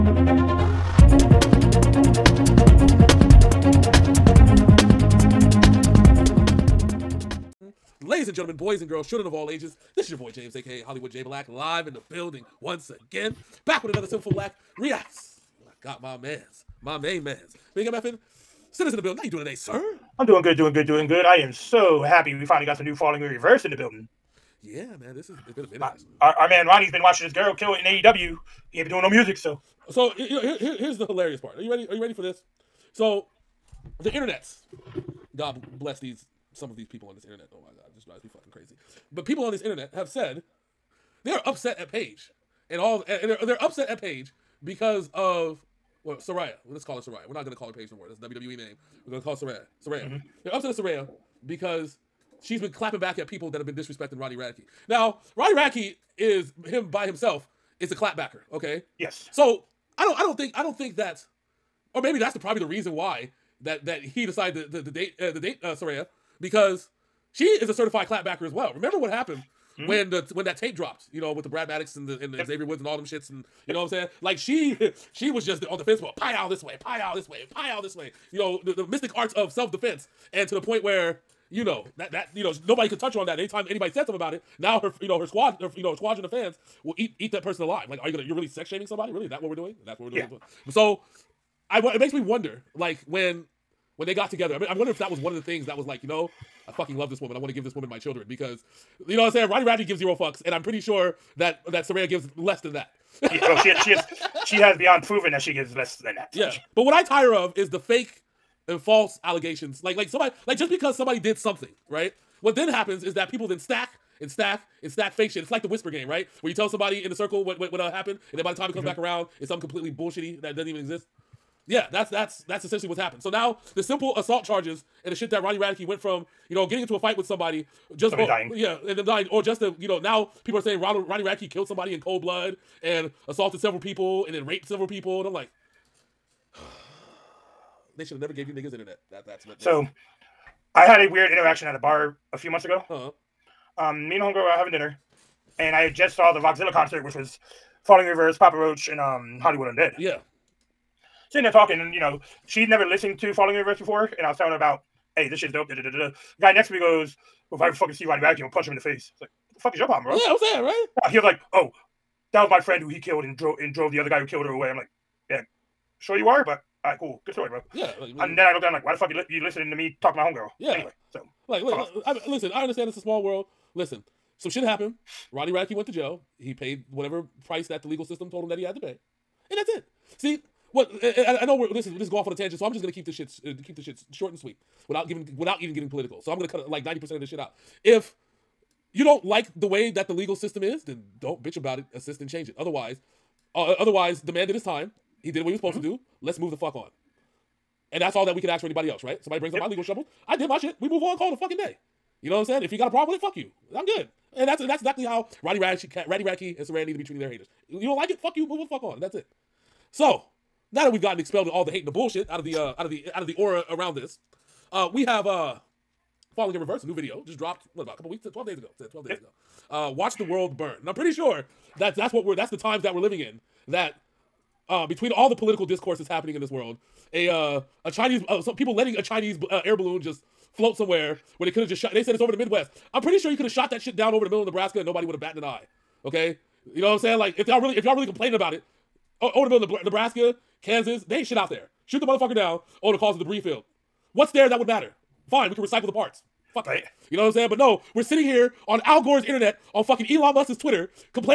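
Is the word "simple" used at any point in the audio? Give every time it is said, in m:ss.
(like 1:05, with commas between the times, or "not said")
2:03.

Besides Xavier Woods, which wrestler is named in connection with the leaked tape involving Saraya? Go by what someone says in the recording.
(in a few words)
Brad Maddox.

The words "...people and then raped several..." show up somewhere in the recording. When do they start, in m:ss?
2:13.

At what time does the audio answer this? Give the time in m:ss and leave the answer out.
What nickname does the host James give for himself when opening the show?
0:10.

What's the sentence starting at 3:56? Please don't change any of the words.
Okay, you know what I'm saying?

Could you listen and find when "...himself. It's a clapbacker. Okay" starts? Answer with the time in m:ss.
0:57.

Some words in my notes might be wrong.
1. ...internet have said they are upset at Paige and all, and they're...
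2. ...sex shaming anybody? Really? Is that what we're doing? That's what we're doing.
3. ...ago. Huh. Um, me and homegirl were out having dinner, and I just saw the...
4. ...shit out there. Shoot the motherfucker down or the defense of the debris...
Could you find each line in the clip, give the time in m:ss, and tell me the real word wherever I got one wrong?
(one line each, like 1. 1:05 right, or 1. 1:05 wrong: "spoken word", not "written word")
1. 0:39 right
2. 1:28 wrong: "somebody", not "anybody"
3. 2:22 right
4. 4:01 wrong: "cause", not "defense".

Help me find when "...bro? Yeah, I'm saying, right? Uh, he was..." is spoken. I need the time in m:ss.
2:40.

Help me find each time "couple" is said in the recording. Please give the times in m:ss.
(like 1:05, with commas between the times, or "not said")
3:37.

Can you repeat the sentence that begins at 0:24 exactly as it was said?
Yeah, man, this is it's been a minute.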